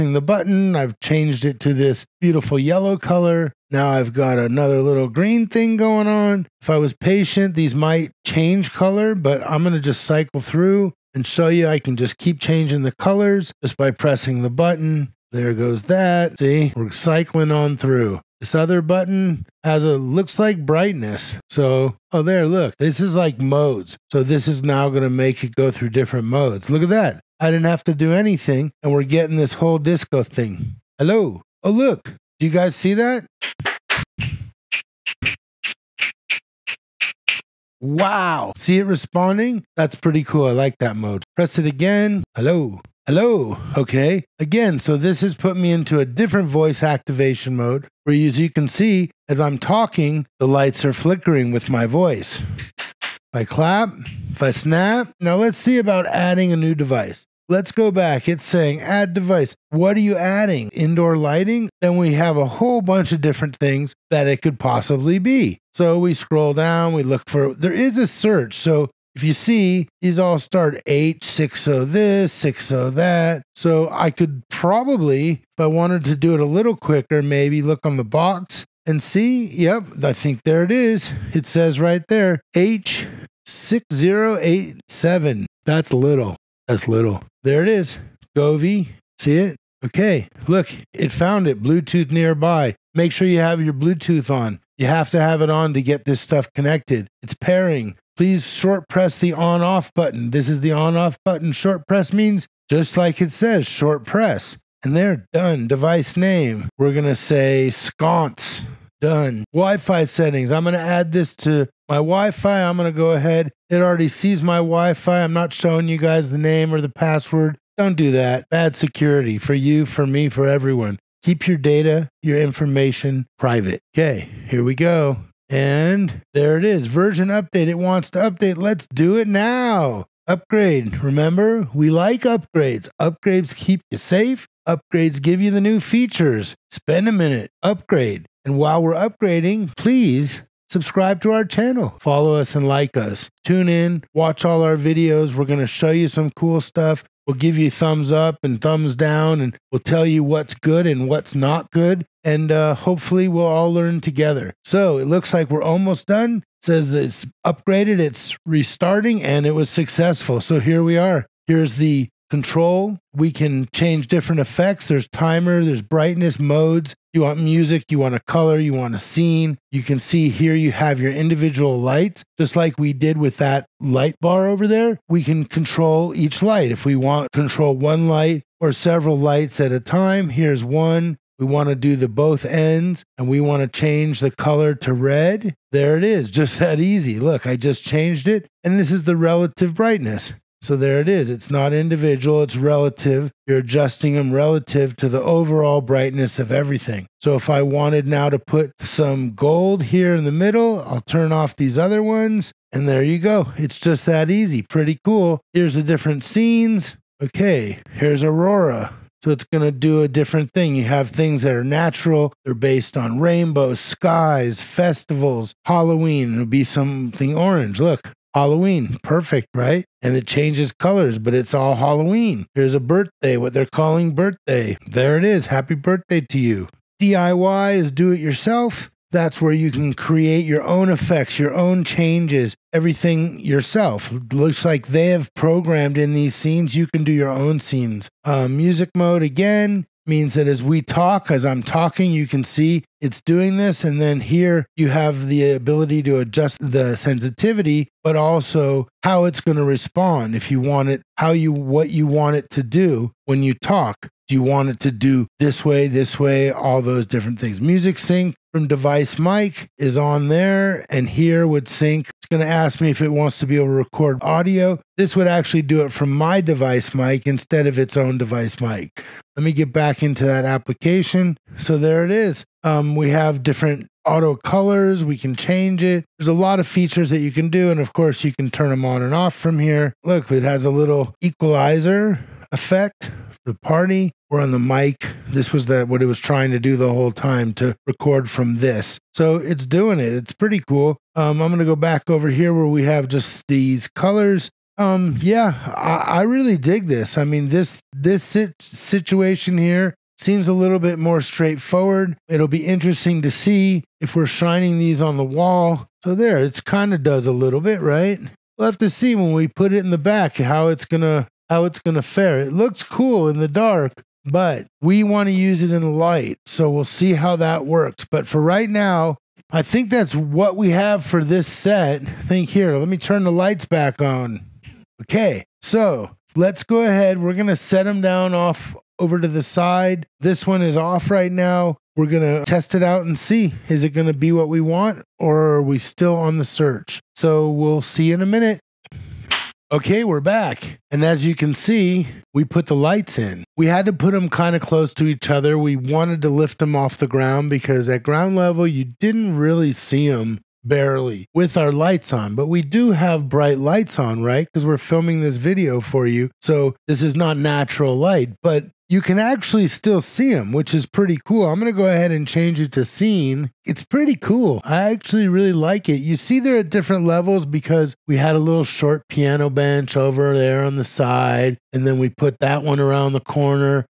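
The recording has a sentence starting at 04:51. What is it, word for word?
Um, I'm going to go back over here where we have just these colors.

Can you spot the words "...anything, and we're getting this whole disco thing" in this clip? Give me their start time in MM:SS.
00:28.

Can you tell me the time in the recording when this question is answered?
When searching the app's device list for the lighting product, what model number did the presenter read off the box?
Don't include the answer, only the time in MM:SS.
01:22.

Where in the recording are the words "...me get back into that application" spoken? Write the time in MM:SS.
04:29.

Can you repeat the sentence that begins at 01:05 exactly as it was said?
So we scroll down, we look for, there is a search.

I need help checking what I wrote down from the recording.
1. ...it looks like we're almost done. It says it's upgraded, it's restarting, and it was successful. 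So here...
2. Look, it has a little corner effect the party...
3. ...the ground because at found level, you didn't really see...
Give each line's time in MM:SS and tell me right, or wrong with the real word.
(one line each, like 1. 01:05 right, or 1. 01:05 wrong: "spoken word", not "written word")
1. 02:34 right
2. 04:40 wrong: "equalizer", not "corner"
3. 05:46 wrong: "ground", not "found".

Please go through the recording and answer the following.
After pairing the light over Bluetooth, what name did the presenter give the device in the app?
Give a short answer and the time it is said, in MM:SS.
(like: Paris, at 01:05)
sconce, at 01:47.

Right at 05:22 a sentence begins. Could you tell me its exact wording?
I think here, let me turn the lights back on.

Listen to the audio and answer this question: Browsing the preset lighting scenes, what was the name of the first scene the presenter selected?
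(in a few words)
Aurora.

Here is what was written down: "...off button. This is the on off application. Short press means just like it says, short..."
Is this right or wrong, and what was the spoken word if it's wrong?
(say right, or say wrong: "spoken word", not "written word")
wrong: "button", not "application".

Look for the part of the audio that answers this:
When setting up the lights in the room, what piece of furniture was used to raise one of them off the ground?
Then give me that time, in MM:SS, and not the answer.
06:09.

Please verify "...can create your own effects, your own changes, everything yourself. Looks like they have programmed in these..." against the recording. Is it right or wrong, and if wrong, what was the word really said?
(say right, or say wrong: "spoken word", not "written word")
right.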